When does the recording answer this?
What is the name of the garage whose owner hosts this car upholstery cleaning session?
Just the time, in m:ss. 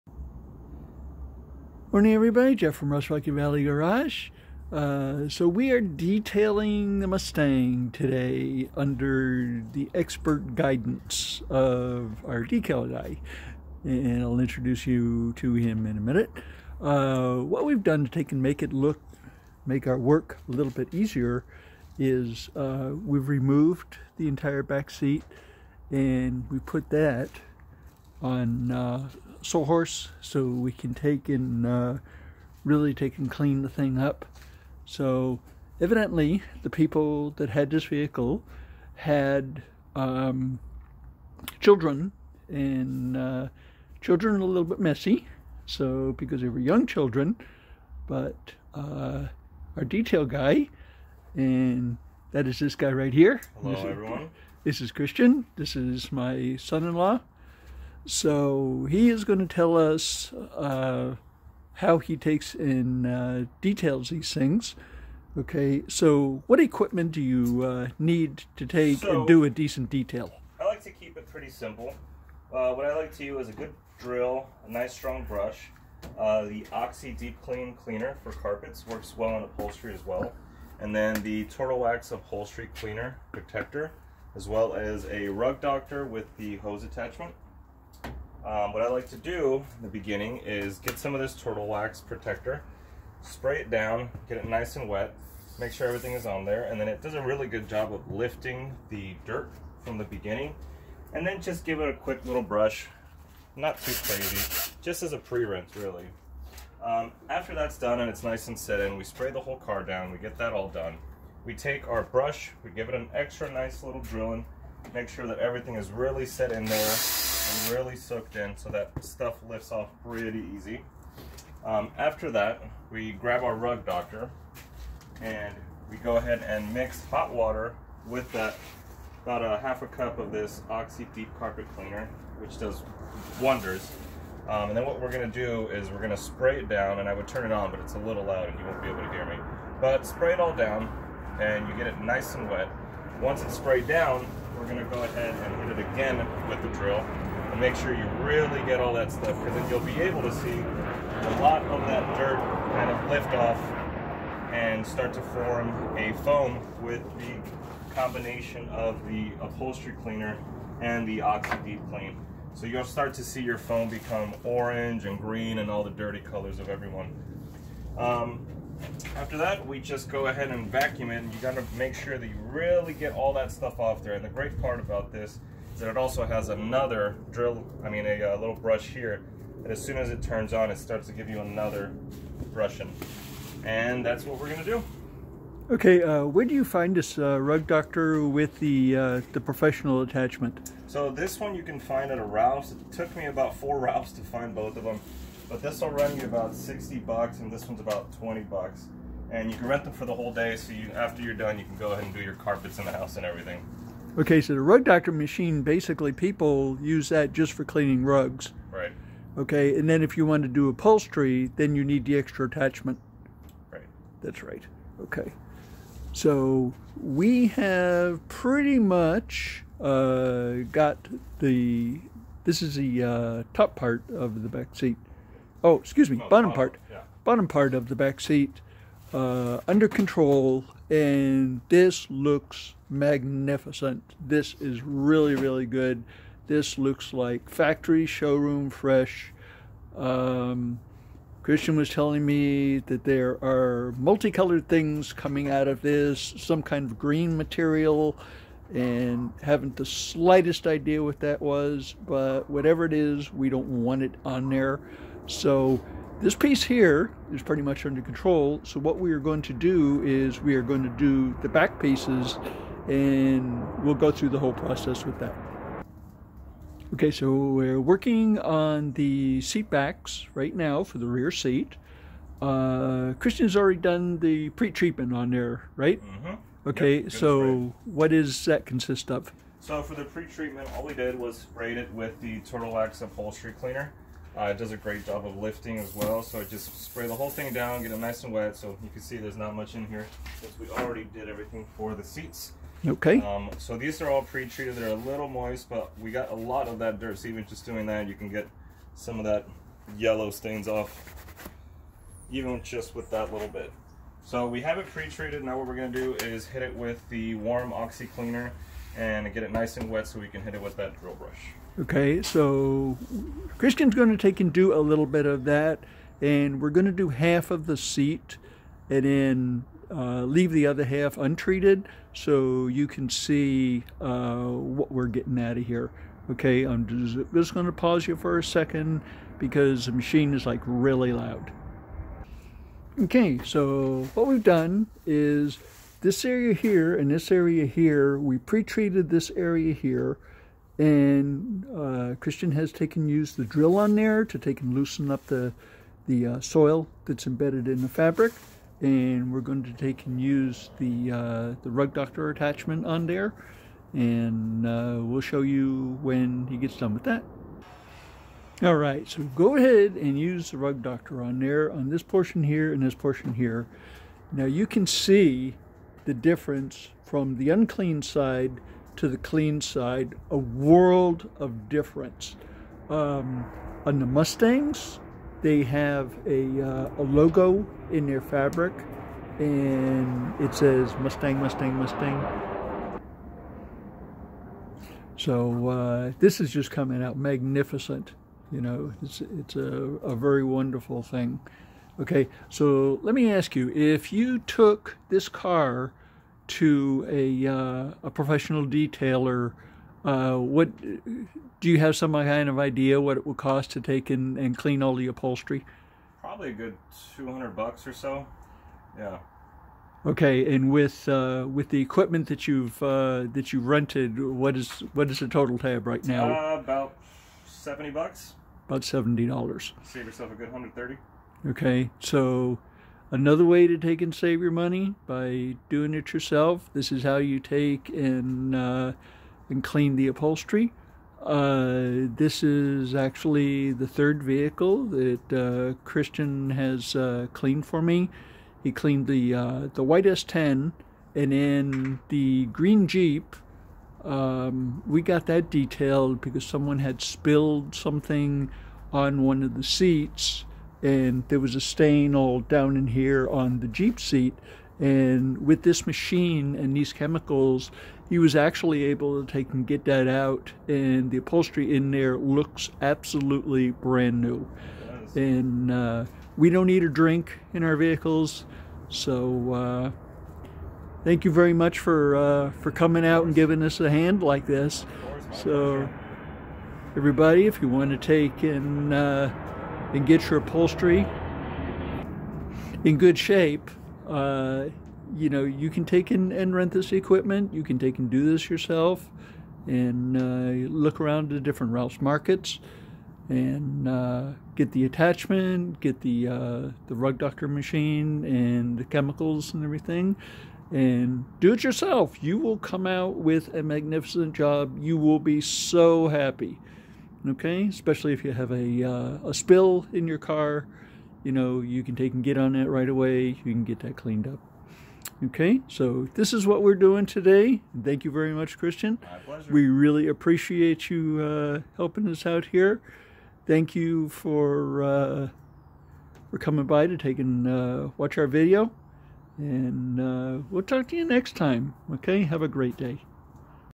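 0:02.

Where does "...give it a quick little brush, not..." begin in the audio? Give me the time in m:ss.
1:41.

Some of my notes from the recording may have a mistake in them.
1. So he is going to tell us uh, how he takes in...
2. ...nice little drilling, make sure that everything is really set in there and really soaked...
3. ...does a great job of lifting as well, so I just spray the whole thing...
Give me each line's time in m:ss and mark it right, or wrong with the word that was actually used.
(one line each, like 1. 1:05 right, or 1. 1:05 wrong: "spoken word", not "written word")
1. 0:58 right
2. 1:53 right
3. 4:44 right.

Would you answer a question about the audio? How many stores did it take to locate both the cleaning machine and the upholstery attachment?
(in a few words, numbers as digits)
4.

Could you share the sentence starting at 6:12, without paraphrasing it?
Um, on the Mustangs, they have a, uh, a logo in their fabric and it says Mustang, Mustang, Mustang.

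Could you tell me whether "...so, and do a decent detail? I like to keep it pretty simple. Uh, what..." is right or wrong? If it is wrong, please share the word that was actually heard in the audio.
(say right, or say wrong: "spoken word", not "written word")
right.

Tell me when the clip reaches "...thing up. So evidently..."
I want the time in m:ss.
0:33.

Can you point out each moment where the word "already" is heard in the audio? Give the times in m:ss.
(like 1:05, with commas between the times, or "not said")
4:33, 4:50.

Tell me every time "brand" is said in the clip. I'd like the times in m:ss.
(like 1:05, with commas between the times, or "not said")
7:43.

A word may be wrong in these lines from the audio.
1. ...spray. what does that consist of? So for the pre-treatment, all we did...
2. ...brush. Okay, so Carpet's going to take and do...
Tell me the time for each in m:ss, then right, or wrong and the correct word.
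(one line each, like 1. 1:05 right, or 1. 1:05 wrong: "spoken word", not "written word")
1. 4:37 right
2. 5:11 wrong: "Christian", not "Carpet".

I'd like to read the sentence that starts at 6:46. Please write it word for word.
Probably a good two hundred bucks or so.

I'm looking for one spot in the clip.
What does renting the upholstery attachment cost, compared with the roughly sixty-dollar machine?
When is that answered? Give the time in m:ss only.
3:18.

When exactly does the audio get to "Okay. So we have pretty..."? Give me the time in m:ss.
3:35.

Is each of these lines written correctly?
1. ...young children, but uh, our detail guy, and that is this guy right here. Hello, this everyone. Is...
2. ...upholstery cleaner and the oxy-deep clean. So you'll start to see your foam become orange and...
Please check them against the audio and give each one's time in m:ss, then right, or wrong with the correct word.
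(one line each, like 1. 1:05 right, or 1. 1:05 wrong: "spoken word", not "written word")
1. 0:46 right
2. 2:39 right.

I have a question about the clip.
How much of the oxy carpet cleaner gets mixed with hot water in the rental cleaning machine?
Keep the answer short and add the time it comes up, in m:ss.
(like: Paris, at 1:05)
half a cup, at 2:09.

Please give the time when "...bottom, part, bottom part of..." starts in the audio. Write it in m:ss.
3:46.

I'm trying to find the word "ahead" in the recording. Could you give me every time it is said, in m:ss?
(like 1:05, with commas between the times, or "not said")
2:06, 2:25, 2:50, 3:21, 5:59.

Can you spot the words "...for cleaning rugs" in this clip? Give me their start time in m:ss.
3:27.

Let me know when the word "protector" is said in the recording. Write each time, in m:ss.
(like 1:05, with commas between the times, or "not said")
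1:23, 1:32.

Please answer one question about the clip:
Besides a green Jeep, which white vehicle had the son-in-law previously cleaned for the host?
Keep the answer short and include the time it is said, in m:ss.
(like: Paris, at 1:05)
S10, at 7:20.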